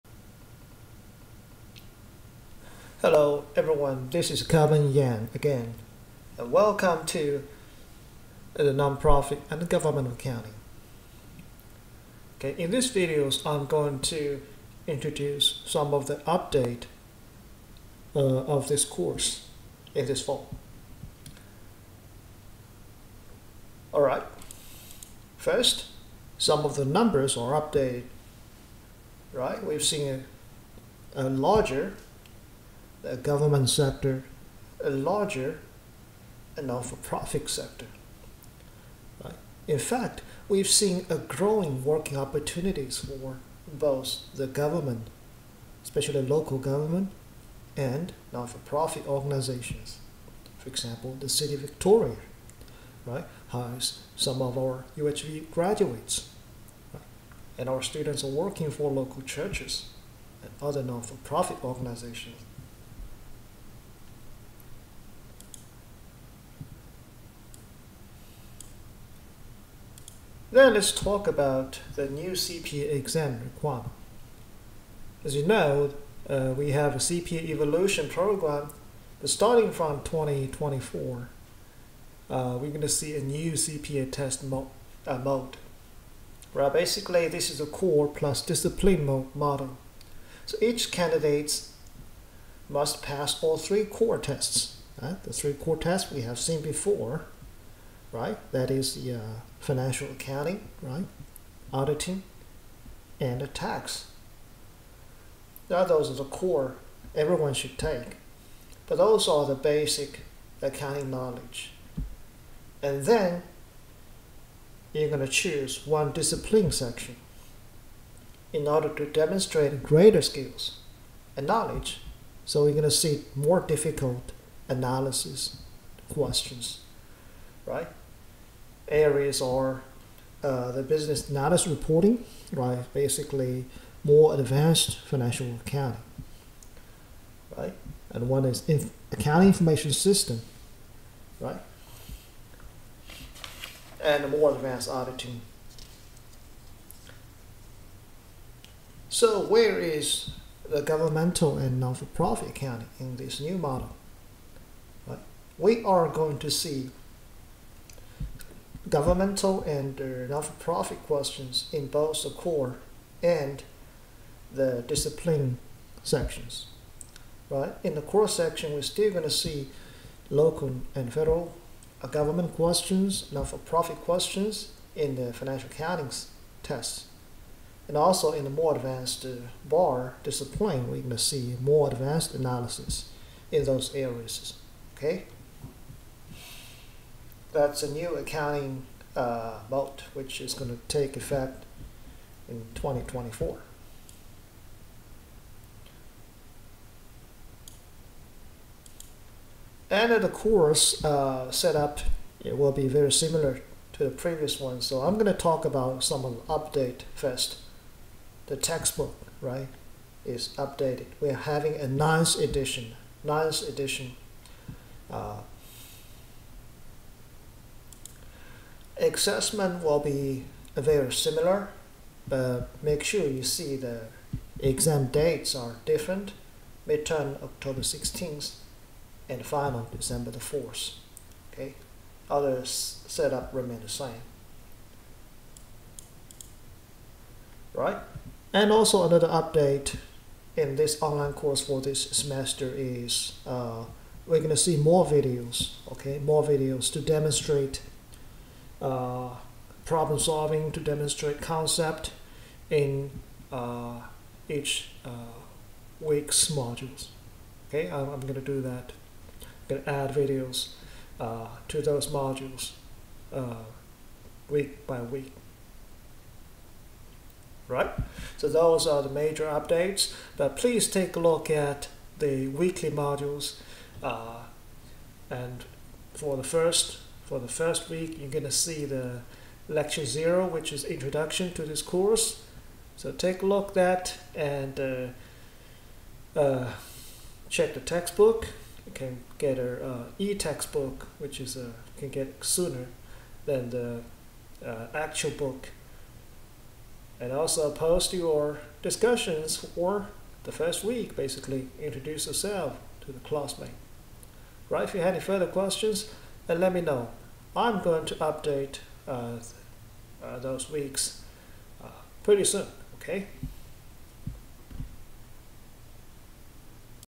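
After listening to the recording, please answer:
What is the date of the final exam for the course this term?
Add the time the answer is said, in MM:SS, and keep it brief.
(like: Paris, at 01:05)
December 4th, at 03:49.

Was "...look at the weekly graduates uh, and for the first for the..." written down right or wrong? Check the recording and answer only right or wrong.
wrong.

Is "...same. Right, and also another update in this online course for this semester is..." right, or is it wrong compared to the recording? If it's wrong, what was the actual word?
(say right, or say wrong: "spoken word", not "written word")
right.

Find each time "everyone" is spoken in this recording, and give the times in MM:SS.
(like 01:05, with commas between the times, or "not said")
00:03, 01:47.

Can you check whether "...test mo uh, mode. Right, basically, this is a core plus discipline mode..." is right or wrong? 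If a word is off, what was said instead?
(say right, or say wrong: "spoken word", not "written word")
right.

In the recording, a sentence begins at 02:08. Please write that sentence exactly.
areas are uh, the business analysis reporting, right?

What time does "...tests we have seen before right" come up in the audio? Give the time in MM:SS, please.
01:35.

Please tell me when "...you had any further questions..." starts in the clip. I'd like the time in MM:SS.
05:04.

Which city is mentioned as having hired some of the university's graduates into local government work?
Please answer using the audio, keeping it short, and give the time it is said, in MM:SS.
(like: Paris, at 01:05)
Victoria, at 00:51.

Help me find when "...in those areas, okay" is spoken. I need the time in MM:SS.
03:03.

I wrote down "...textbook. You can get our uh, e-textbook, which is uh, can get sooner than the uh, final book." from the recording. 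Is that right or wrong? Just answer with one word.
wrong.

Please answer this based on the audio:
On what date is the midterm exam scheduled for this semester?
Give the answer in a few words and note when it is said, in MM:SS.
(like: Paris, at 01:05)
October 16th, at 03:47.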